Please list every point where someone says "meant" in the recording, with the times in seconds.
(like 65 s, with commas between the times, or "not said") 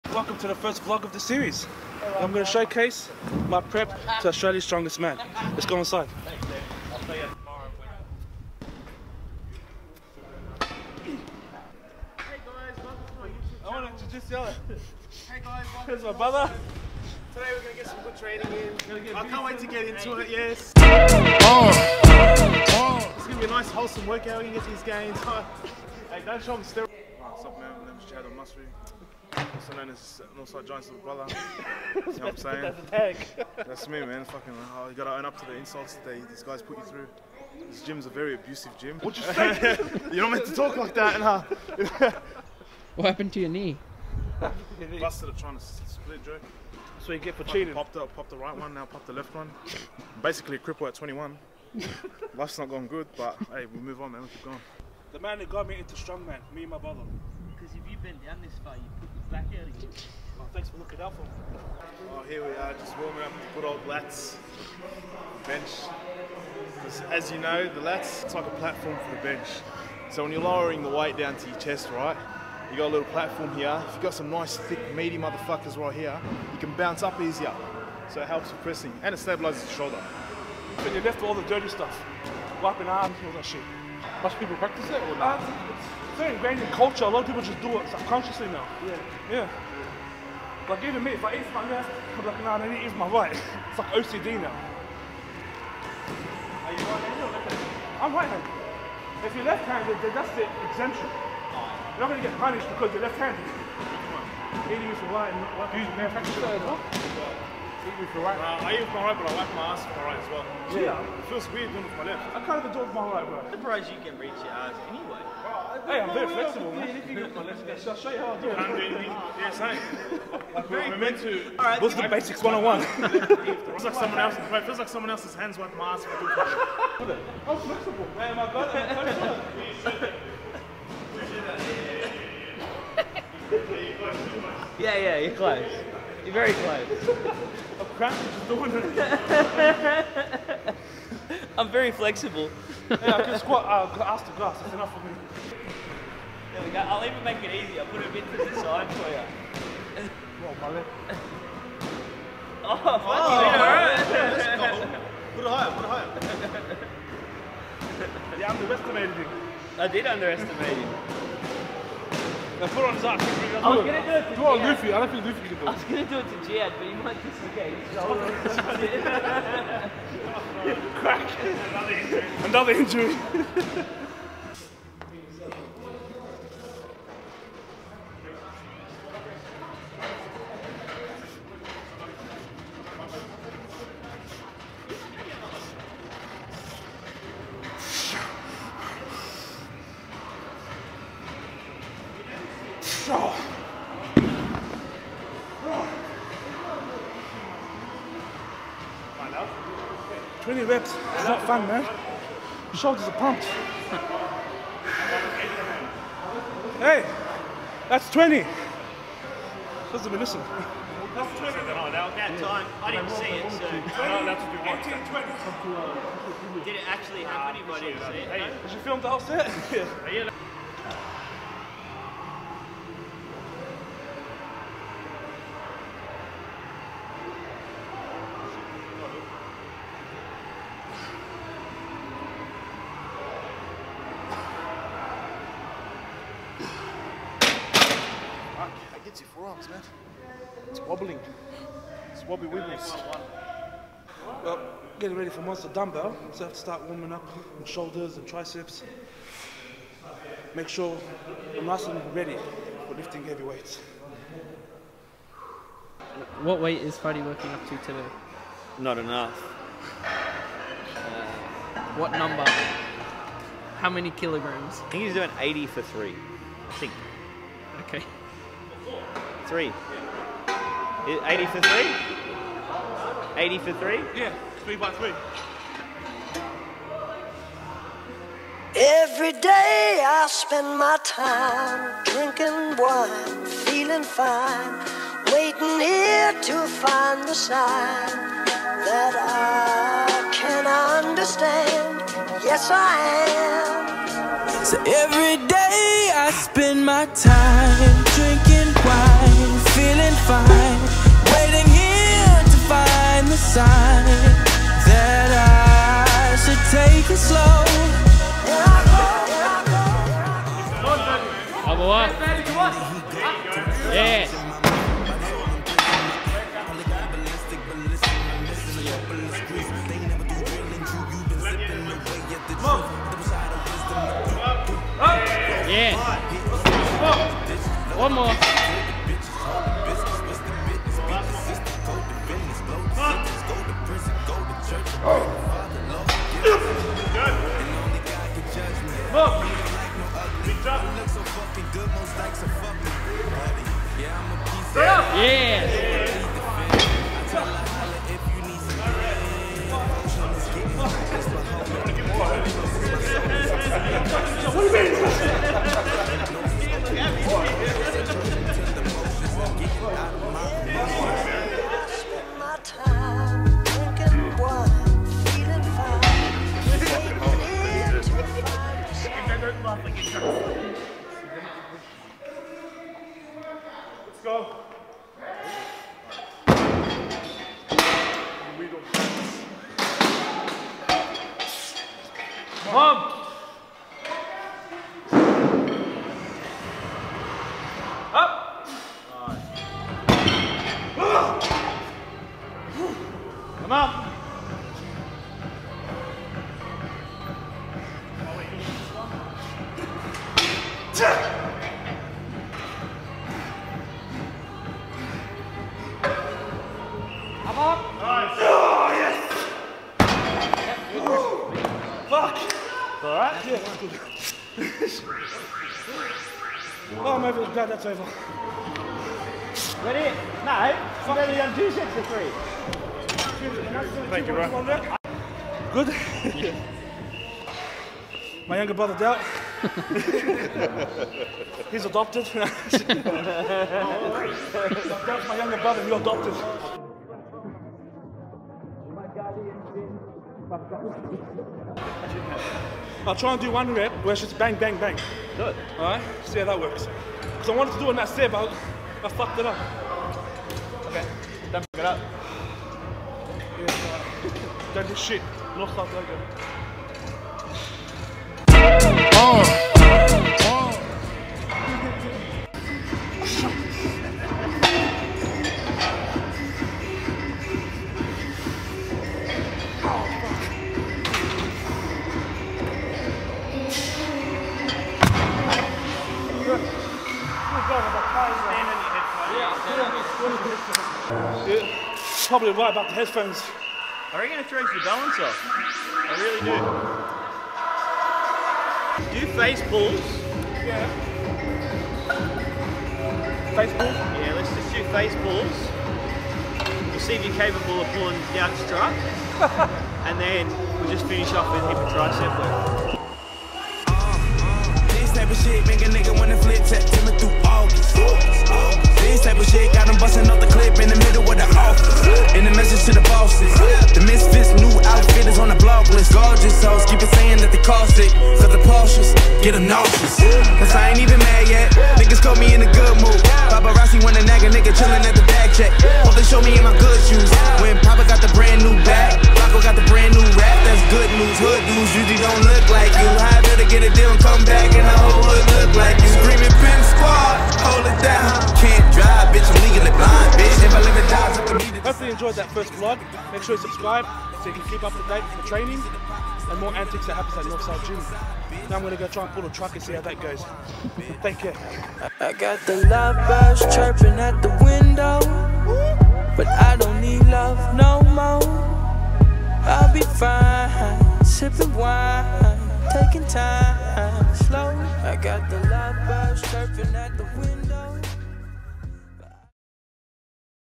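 40 s, 120 s.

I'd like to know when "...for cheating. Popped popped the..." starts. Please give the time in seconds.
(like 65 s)
47 s.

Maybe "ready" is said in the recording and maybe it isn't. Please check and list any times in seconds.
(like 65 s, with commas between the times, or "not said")
245 s, 252 s, 419 s.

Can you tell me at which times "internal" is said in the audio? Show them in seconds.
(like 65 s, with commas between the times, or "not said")
not said.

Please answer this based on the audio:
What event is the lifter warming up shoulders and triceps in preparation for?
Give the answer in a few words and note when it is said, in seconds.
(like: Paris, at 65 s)
Monster dumbbell, at 245 s.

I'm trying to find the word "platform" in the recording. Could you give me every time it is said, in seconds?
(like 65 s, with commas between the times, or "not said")
68 s, 73 s.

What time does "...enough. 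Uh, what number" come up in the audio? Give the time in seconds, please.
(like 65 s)
258 s.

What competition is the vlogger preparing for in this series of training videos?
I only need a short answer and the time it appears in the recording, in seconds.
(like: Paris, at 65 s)
Australia's Strongest Man, at 4 s.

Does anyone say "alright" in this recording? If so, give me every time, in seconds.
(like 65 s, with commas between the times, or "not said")
153 s, 445 s.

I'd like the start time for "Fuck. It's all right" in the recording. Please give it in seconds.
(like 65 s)
412 s.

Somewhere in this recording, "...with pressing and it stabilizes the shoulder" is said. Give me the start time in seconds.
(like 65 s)
78 s.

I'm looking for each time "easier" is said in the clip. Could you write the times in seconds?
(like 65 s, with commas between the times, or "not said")
77 s, 147 s.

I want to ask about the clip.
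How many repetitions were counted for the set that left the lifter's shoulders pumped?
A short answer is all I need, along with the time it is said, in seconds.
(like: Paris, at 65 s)
20, at 200 s.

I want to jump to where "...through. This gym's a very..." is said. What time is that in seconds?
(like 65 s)
36 s.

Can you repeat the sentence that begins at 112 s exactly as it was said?
I kind of adore with my right, bro.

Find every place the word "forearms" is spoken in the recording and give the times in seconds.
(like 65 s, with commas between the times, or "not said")
239 s.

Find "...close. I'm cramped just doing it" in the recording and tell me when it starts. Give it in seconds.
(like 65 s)
136 s.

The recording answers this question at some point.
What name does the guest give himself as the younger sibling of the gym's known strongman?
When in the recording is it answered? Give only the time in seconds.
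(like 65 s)
28 s.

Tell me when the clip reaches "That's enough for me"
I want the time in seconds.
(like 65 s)
144 s.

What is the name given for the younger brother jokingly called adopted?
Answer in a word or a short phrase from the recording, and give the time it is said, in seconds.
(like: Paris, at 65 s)
Dell, at 428 s.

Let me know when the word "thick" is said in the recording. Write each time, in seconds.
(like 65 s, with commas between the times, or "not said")
74 s.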